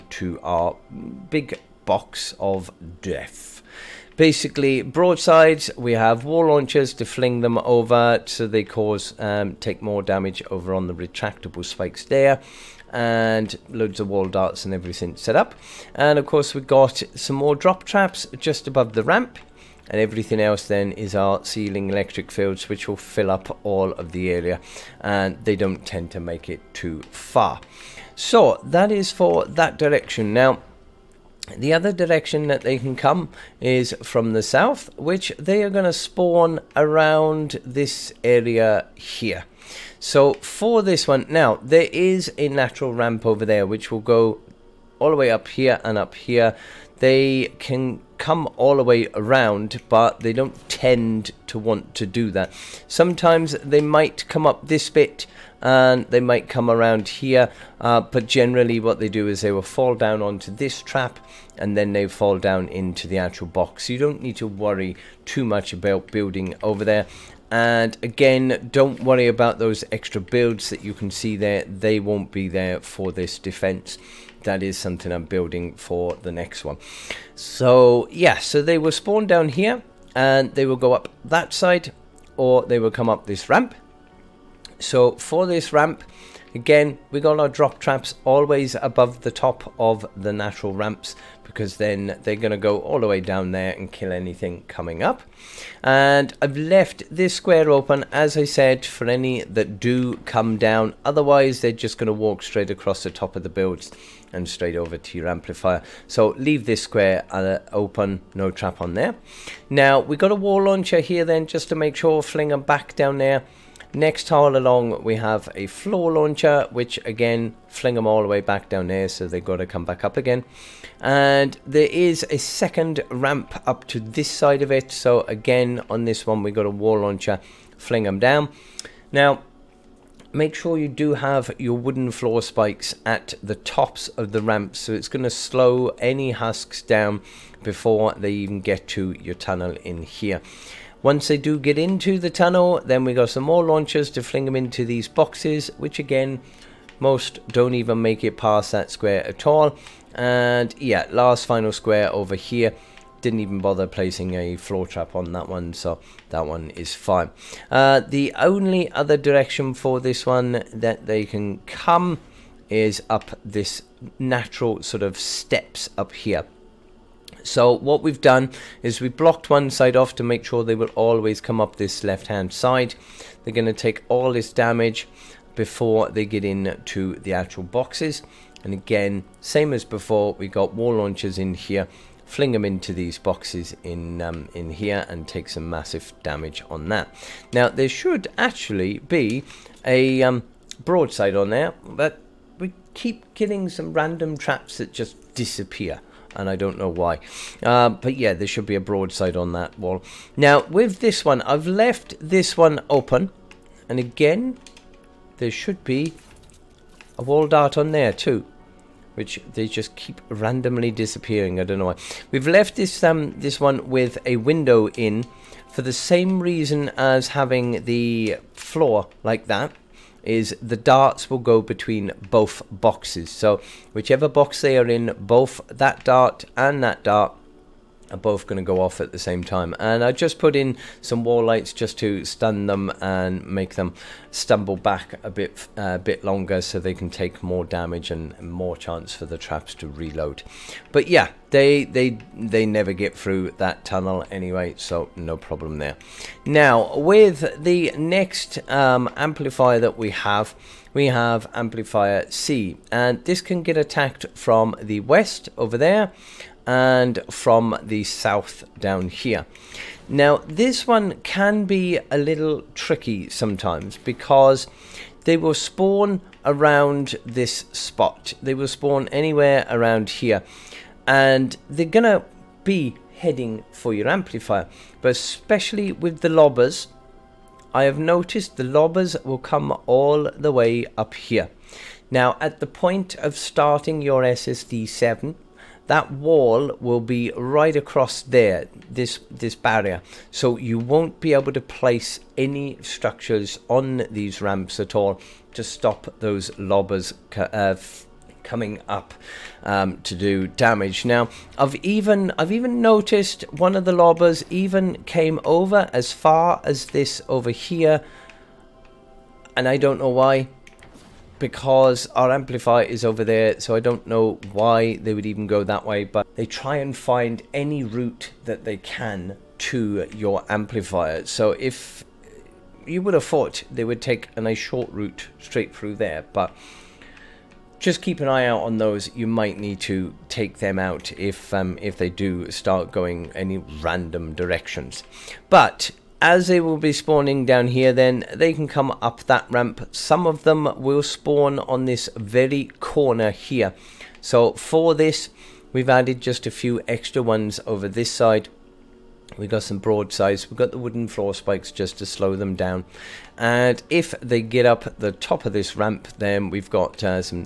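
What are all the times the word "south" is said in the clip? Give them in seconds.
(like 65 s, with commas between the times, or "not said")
34 s, 258 s.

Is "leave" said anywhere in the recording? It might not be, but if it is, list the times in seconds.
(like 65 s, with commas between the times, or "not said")
106 s.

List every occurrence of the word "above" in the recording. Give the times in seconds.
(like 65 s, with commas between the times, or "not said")
18 s, 88 s.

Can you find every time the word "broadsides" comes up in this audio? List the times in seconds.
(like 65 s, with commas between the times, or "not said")
4 s, 190 s, 198 s, 349 s.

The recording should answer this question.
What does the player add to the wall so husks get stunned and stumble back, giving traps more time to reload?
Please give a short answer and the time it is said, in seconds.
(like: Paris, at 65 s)
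Wall lights, at 231 s.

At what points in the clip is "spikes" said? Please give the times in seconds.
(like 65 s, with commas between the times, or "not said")
11 s, 132 s, 351 s.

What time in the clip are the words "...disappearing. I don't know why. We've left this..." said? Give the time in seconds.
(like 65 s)
210 s.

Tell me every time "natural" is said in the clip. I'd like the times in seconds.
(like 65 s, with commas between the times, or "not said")
42 s, 90 s, 164 s.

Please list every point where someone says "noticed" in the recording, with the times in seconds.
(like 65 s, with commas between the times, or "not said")
277 s, 302 s.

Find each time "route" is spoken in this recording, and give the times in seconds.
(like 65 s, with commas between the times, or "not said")
317 s, 324 s.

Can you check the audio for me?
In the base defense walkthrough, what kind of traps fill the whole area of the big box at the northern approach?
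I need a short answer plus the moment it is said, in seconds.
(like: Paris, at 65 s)
Ceiling electric fields, at 21 s.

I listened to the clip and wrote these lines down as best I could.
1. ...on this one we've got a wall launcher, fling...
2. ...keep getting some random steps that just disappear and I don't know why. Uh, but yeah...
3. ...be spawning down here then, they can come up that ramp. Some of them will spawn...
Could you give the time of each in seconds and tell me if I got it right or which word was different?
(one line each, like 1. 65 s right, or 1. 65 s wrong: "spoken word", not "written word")
1. 125 s right
2. 192 s wrong: "traps", not "steps"
3. 336 s right.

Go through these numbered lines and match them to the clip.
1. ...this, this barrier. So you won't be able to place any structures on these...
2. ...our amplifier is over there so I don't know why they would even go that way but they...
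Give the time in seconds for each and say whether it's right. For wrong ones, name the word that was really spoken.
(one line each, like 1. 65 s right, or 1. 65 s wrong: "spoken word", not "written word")
1. 288 s right
2. 312 s right.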